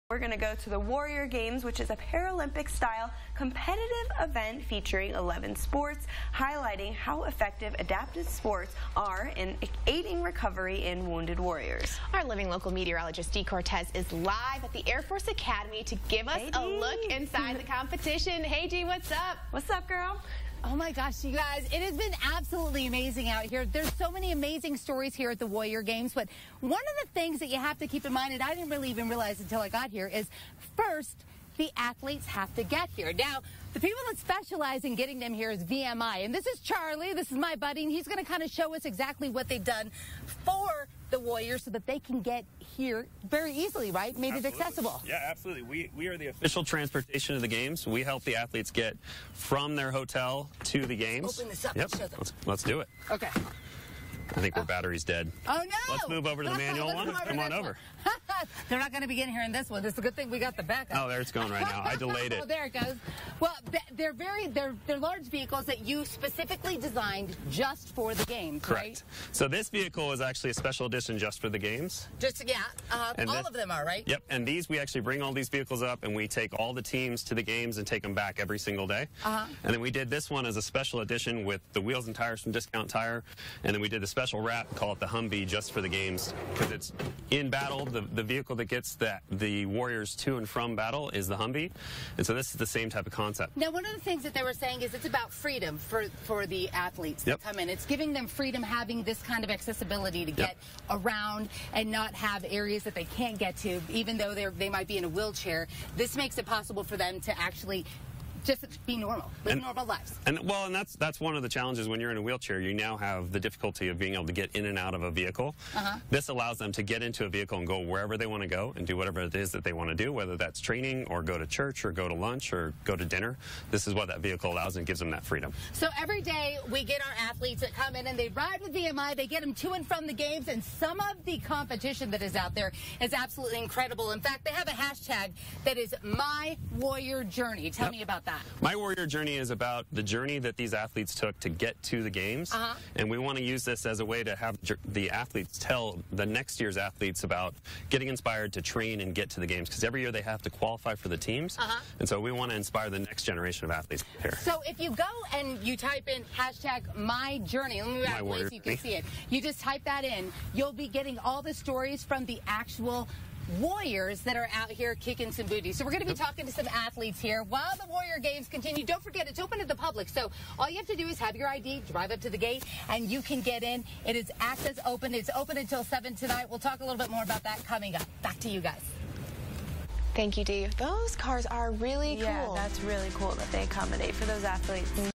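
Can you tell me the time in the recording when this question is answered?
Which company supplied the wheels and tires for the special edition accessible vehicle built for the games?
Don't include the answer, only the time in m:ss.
1:22.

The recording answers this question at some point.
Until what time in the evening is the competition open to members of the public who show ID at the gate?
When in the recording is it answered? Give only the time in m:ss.
2:55.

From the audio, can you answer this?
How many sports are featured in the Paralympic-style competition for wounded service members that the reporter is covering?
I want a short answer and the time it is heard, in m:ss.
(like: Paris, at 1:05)
11, at 0:05.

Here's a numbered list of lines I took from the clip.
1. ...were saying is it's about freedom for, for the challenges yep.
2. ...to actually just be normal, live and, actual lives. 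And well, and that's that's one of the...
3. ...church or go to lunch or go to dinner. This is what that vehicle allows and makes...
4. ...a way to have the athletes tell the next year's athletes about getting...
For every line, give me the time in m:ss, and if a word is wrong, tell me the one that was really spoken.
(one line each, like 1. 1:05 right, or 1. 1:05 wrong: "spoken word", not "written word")
1. 1:34 wrong: "athletes", not "challenges"
2. 1:47 wrong: "normal", not "actual"
3. 2:01 wrong: "gives", not "makes"
4. 2:23 right.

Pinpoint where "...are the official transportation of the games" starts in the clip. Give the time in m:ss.
0:46.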